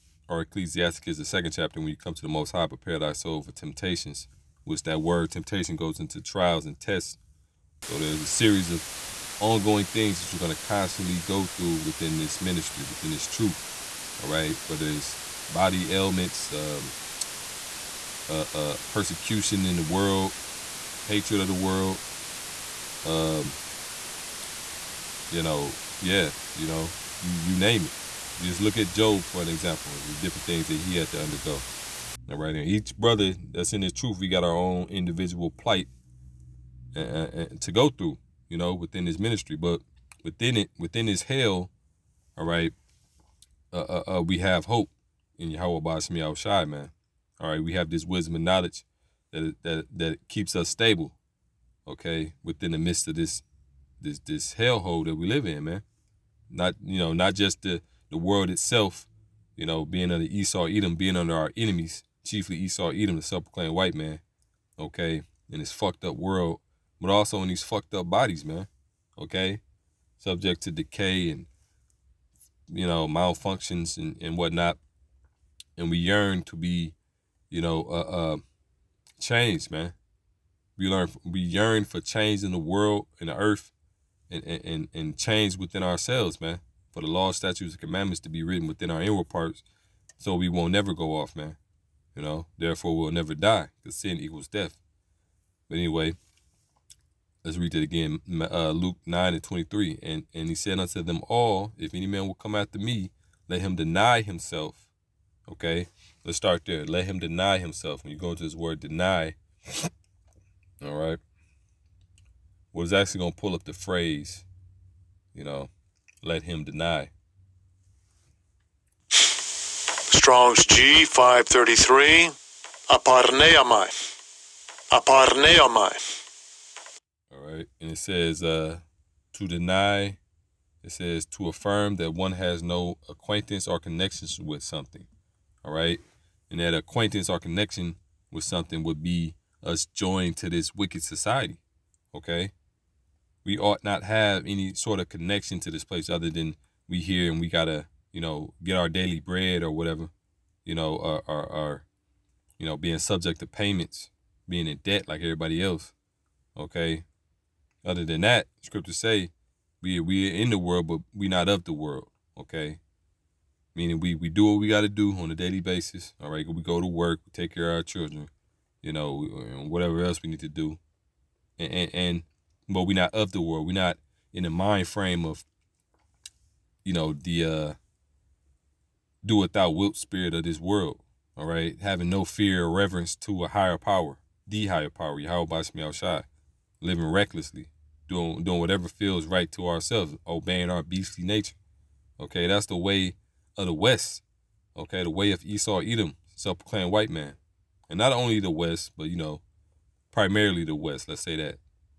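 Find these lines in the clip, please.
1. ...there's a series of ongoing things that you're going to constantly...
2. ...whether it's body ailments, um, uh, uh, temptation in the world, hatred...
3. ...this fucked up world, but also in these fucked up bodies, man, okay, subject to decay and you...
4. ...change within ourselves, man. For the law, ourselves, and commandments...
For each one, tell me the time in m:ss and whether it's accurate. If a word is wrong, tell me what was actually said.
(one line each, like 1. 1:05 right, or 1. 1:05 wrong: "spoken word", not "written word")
1. 0:07 right
2. 0:14 wrong: "persecution", not "temptation"
3. 1:05 right
4. 1:25 wrong: "statutes", not "ourselves".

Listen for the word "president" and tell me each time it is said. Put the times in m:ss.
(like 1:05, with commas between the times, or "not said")
not said.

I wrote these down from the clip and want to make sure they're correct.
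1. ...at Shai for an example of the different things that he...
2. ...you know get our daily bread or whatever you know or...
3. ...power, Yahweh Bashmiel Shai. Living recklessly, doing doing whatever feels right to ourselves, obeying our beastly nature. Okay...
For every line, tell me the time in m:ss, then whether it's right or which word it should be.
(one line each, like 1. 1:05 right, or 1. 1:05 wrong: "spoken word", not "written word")
1. 0:28 wrong: "Job", not "Shai"
2. 2:28 right
3. 3:04 right.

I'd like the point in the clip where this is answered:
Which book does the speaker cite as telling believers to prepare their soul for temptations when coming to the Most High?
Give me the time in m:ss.
0:00.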